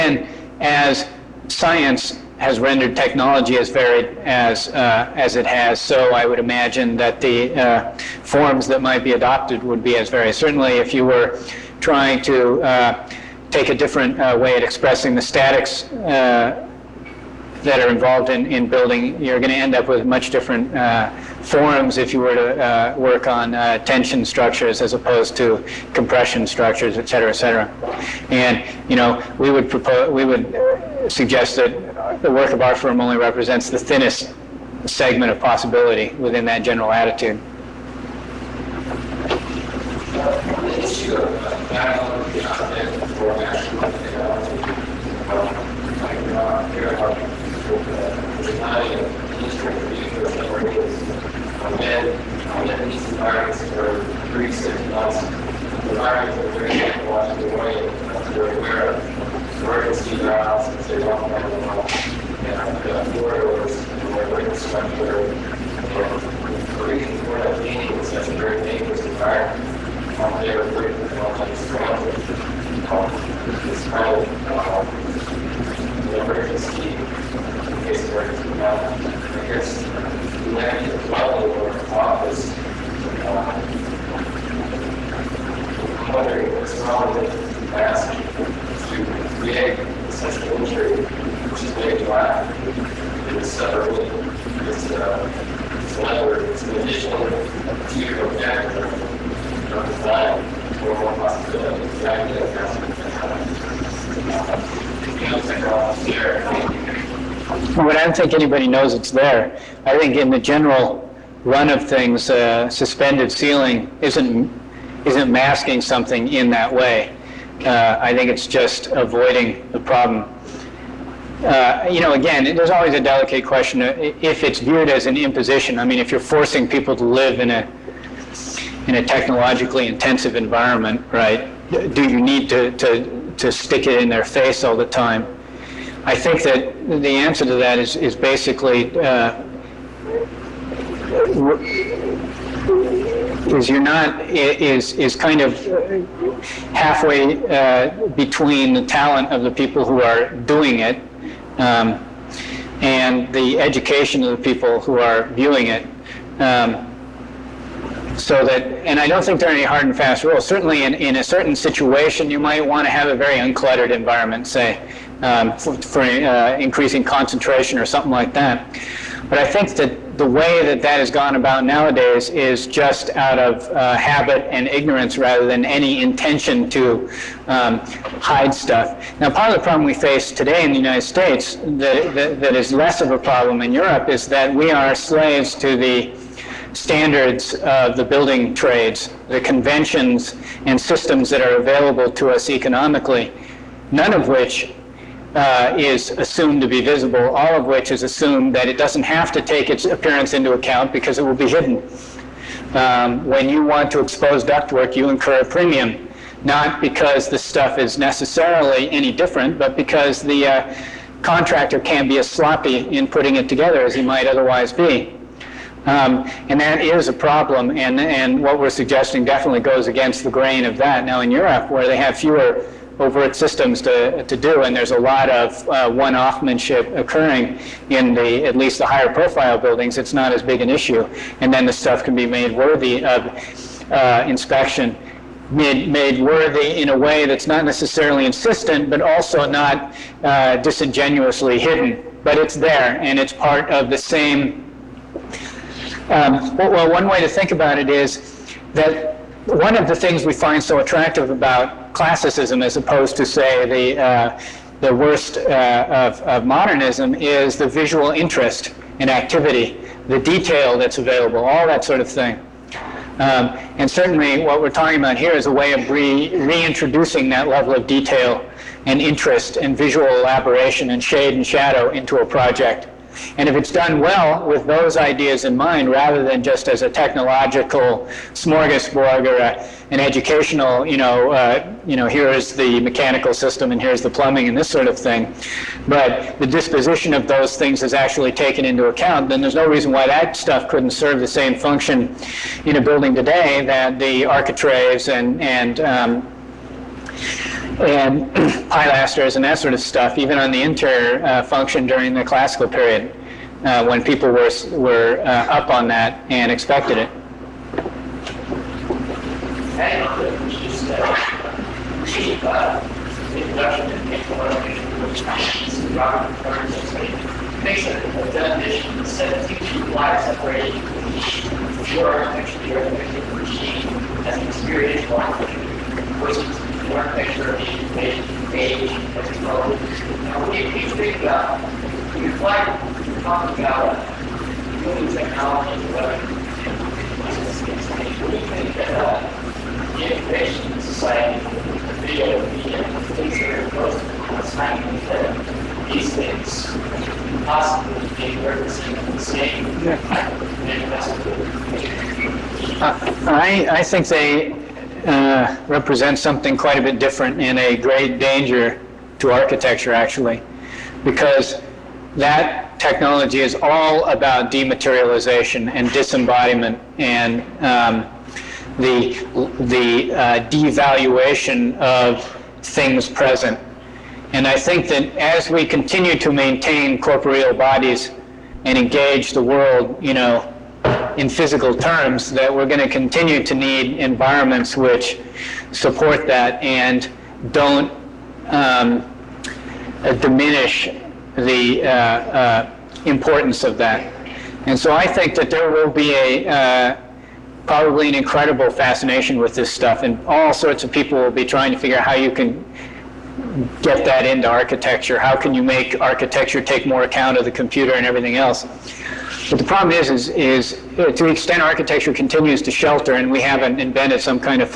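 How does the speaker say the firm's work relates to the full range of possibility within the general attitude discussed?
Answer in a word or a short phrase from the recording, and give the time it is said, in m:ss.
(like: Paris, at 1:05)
the thinnest segment, at 0:33.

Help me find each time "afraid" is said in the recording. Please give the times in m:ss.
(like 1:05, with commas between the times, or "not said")
1:10.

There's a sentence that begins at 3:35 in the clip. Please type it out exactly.
Um, and that is a problem, and, and what we're suggesting definitely goes against the grain of that.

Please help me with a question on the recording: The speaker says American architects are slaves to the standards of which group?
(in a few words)
the building trades.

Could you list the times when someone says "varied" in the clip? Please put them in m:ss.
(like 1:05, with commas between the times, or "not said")
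0:03, 0:10.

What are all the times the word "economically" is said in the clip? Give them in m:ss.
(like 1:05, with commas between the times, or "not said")
3:12.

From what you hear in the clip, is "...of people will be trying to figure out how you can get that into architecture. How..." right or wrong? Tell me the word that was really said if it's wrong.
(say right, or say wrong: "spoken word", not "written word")
right.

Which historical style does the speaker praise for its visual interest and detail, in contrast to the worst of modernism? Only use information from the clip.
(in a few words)
classicism.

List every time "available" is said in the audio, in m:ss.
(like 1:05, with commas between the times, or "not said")
3:11, 4:20.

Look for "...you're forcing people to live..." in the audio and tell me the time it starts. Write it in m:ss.
2:06.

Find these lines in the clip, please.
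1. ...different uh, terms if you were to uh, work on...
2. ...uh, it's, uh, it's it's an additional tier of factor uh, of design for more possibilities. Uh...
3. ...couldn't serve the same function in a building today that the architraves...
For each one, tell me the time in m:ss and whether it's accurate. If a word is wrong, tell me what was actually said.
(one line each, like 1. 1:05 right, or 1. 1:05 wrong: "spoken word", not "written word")
1. 0:20 wrong: "forums", not "terms"
2. 1:33 right
3. 4:50 right.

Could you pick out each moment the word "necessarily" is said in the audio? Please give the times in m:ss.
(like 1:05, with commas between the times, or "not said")
3:27, 3:57.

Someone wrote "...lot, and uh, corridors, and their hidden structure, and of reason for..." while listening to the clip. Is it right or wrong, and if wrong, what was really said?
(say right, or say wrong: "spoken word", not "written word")
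wrong: "written", not "hidden".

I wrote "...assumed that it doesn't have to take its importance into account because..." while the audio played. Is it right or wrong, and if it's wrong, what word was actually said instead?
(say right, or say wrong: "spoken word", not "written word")
wrong: "appearance", not "importance".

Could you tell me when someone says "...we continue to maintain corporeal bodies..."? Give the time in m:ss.
6:15.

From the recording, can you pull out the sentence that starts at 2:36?
Um, so that, and I don't think there are any hard and fast rules.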